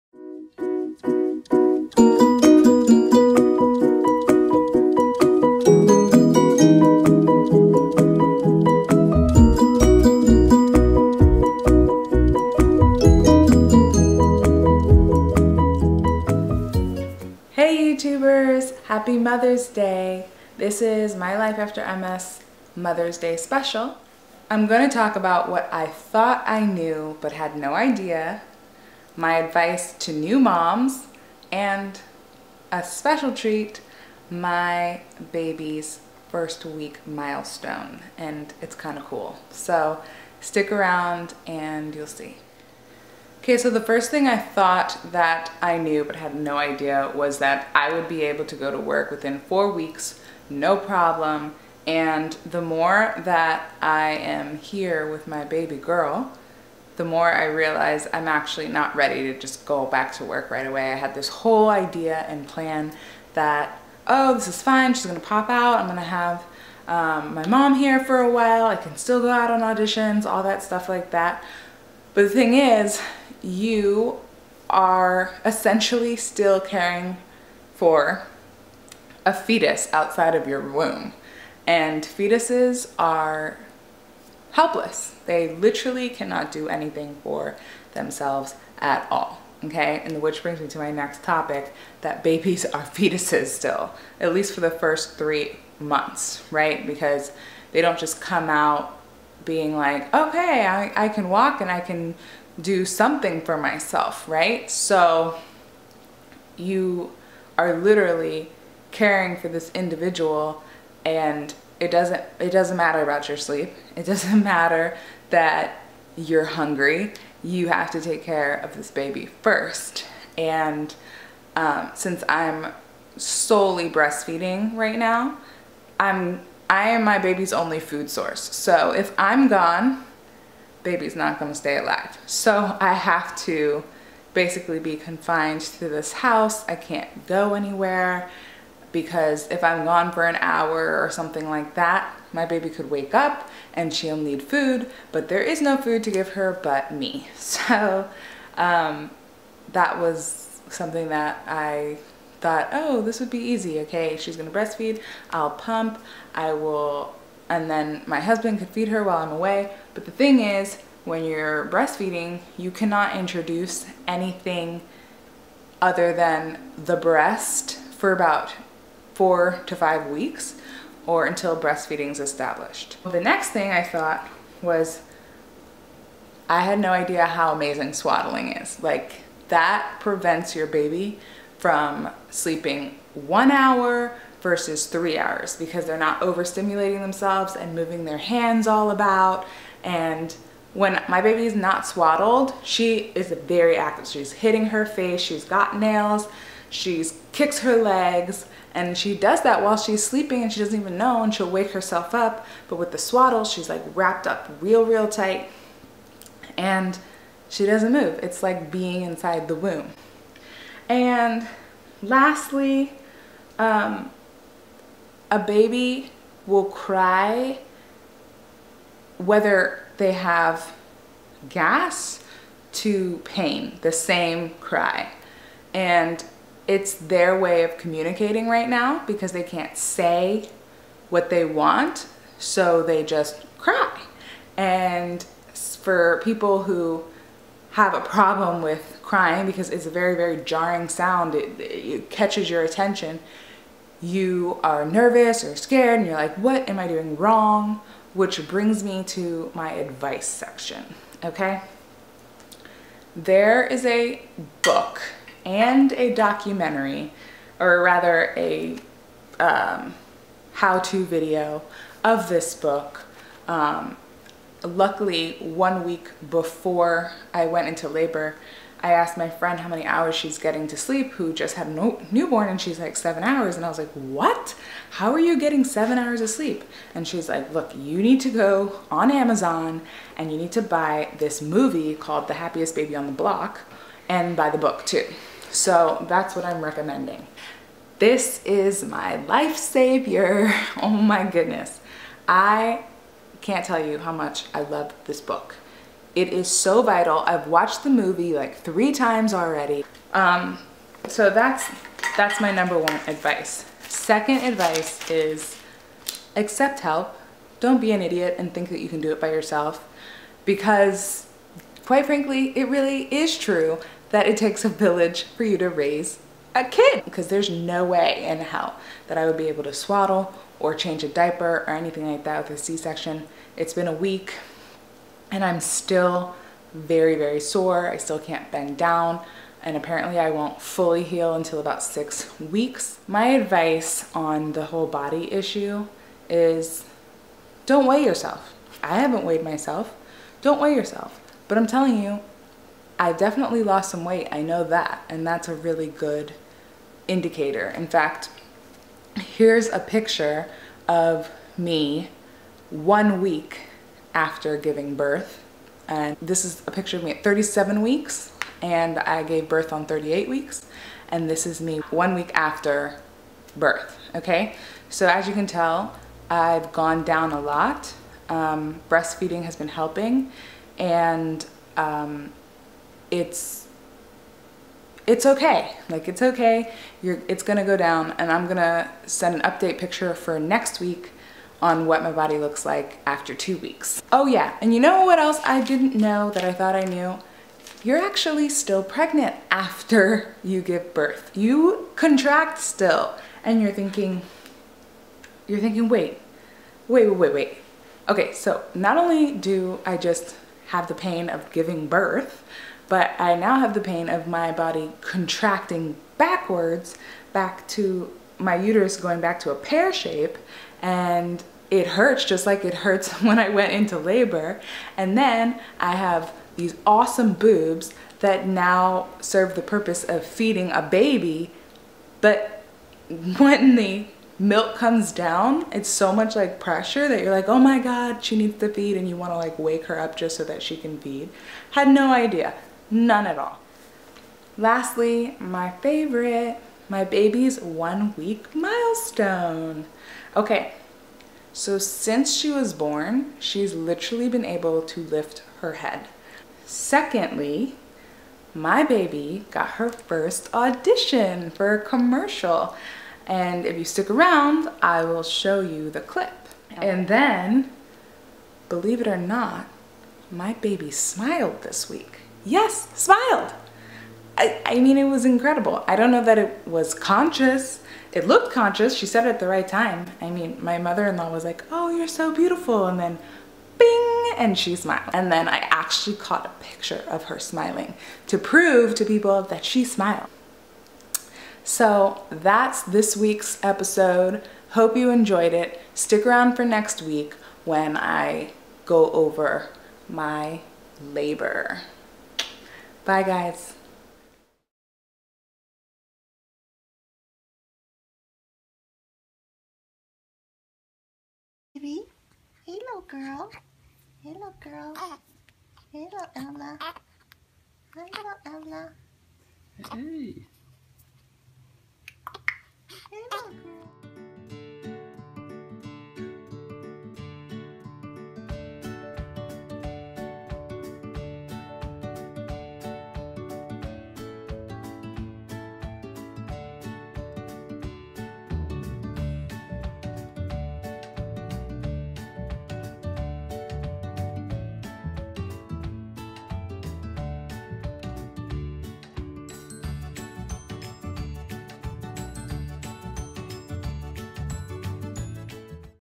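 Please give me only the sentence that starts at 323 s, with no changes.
It's been a week and I'm still very, very sore.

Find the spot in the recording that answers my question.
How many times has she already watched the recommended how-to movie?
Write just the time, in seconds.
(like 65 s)
298 s.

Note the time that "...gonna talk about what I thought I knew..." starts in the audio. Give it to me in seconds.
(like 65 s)
24 s.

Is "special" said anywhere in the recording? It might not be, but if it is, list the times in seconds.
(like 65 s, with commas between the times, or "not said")
23 s, 32 s.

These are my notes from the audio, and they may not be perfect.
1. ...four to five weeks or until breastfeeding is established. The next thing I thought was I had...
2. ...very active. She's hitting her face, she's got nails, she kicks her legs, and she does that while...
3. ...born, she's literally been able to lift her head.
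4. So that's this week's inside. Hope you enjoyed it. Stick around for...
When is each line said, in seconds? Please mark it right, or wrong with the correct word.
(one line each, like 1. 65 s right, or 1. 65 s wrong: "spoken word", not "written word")
1. 169 s right
2. 193 s right
3. 442 s right
4. 481 s wrong: "episode", not "inside".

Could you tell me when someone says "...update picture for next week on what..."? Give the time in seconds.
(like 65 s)
379 s.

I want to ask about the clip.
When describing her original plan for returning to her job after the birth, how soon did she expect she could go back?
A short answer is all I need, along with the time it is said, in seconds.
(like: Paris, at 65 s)
Within four weeks, at 49 s.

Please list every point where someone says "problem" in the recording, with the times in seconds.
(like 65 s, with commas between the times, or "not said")
50 s, 238 s.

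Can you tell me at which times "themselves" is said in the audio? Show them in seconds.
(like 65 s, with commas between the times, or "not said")
87 s, 187 s.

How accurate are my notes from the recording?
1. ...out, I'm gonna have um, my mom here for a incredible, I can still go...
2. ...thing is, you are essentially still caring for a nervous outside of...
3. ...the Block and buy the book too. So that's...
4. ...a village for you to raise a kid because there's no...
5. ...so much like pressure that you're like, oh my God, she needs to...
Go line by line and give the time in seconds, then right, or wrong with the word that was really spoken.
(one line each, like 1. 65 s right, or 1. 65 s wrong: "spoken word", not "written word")
1. 65 s wrong: "while", not "incredible"
2. 72 s wrong: "fetus", not "nervous"
3. 283 s right
4. 314 s right
5. 425 s right.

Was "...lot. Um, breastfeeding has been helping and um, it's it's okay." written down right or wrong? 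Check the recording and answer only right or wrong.
right.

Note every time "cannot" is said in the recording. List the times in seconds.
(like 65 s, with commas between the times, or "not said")
86 s, 162 s.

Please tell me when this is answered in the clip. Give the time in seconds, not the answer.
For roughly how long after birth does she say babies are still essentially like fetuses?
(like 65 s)
94 s.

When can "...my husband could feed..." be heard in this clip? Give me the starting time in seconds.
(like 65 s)
158 s.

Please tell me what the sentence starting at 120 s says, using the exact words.
And um, since I'm solely breastfeeding right now, I'm I am my baby's only food source.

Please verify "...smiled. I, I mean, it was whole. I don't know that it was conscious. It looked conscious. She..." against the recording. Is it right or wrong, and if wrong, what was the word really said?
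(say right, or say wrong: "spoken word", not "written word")
wrong: "incredible", not "whole".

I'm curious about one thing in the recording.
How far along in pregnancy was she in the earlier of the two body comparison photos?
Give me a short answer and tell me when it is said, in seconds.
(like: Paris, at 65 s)
37 weeks, at 357 s.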